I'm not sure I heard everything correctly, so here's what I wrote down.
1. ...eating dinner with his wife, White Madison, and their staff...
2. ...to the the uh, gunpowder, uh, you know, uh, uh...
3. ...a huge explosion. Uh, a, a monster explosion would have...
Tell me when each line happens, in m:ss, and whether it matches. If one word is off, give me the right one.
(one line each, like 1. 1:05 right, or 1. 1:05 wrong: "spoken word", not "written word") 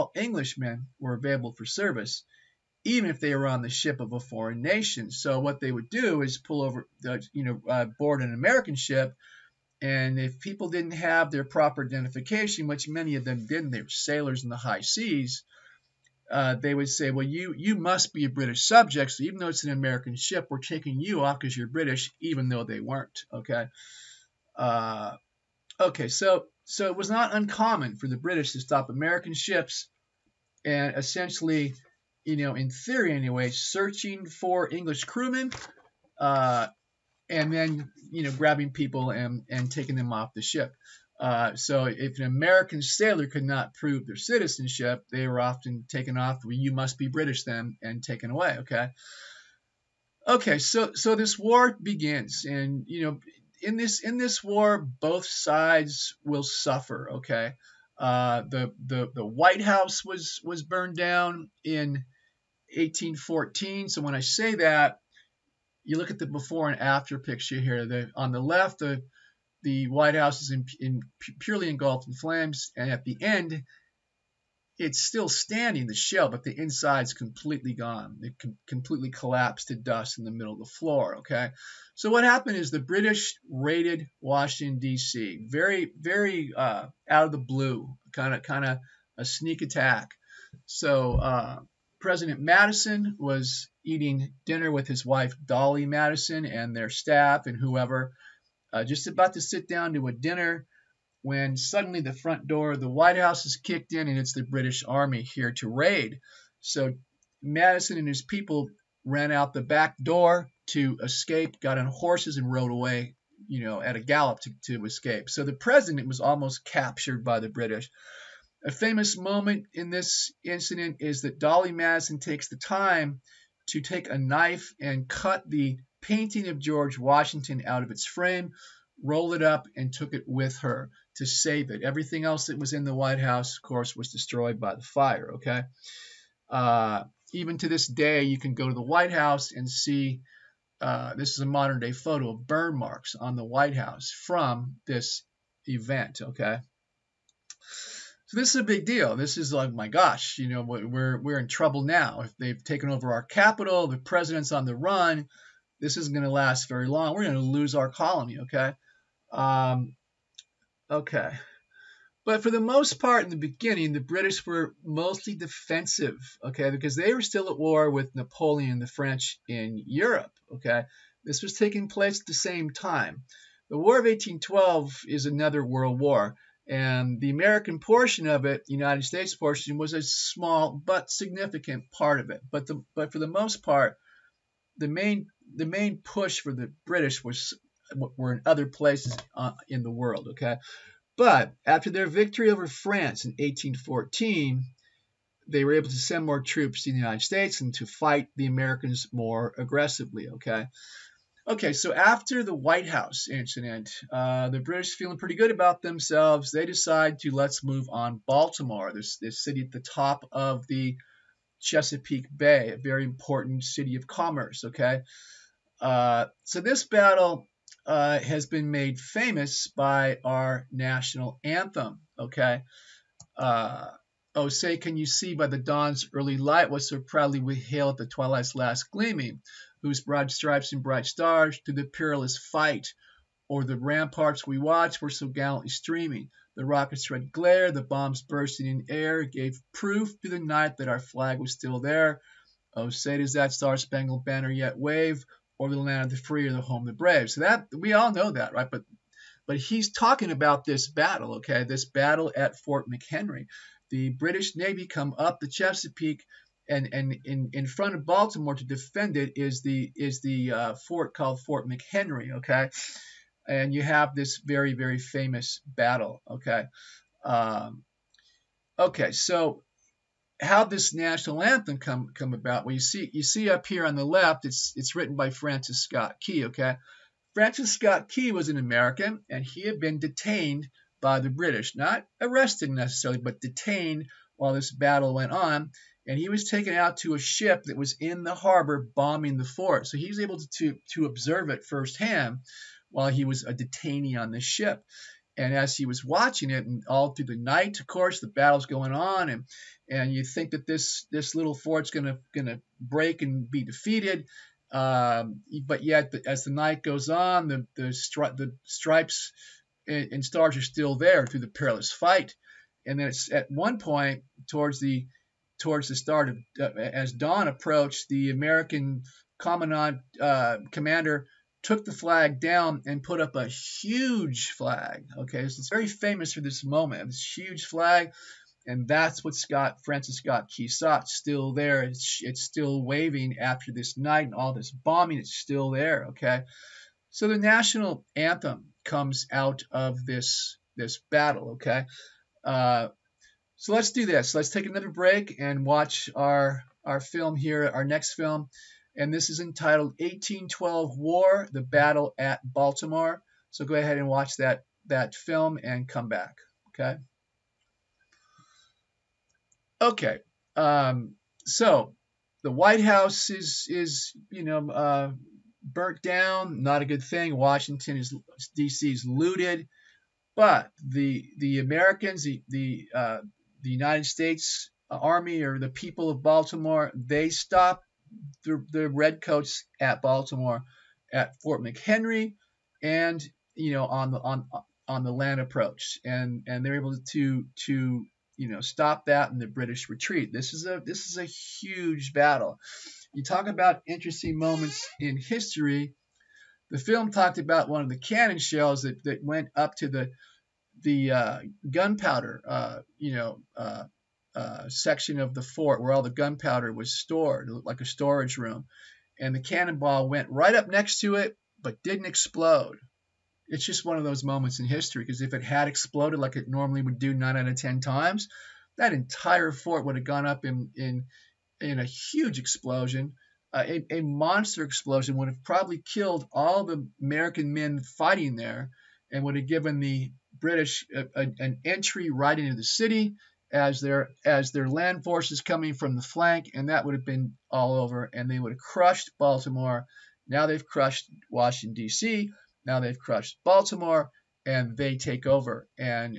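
1. 1:33 wrong: "Dolley", not "White"
2. 6:39 right
3. 7:01 right.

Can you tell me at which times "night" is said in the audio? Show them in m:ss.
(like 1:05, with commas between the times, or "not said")
4:00, 4:57, 5:06, 5:33.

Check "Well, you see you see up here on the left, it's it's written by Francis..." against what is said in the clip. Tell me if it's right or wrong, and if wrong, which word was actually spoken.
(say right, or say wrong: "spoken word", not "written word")
right.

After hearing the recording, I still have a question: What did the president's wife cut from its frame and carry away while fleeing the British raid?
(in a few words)
painting of George Washington.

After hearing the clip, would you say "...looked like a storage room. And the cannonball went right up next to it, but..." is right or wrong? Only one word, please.
right.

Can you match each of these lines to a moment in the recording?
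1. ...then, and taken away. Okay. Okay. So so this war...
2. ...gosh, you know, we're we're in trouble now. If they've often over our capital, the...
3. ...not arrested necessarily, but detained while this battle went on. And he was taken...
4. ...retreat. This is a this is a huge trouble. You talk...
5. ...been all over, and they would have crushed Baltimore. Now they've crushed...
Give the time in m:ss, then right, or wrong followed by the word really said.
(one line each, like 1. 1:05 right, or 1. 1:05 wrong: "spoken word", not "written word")
1. 0:47 right
2. 2:29 wrong: "taken", not "often"
3. 4:41 right
4. 6:29 wrong: "battle", not "trouble"
5. 7:17 right.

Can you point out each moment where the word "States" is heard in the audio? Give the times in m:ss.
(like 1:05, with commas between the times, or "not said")
2:59, 3:17, 6:14.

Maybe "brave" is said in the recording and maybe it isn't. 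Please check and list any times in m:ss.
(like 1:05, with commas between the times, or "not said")
4:06.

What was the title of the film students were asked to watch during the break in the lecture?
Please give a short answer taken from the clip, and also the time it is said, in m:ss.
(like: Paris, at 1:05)
1812 War: The Battle at Baltimore, at 5:49.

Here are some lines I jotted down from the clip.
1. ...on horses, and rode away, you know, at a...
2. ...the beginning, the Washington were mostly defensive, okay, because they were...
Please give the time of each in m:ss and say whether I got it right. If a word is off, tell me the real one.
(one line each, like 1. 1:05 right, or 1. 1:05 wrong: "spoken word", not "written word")
1. 1:51 right
2. 2:43 wrong: "British", not "Washington".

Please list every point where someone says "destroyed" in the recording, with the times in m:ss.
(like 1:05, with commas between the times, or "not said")
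2:14.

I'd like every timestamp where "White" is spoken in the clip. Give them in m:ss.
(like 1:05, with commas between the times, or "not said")
0:59, 1:09, 1:42, 2:12, 2:18, 2:23, 3:22, 6:02.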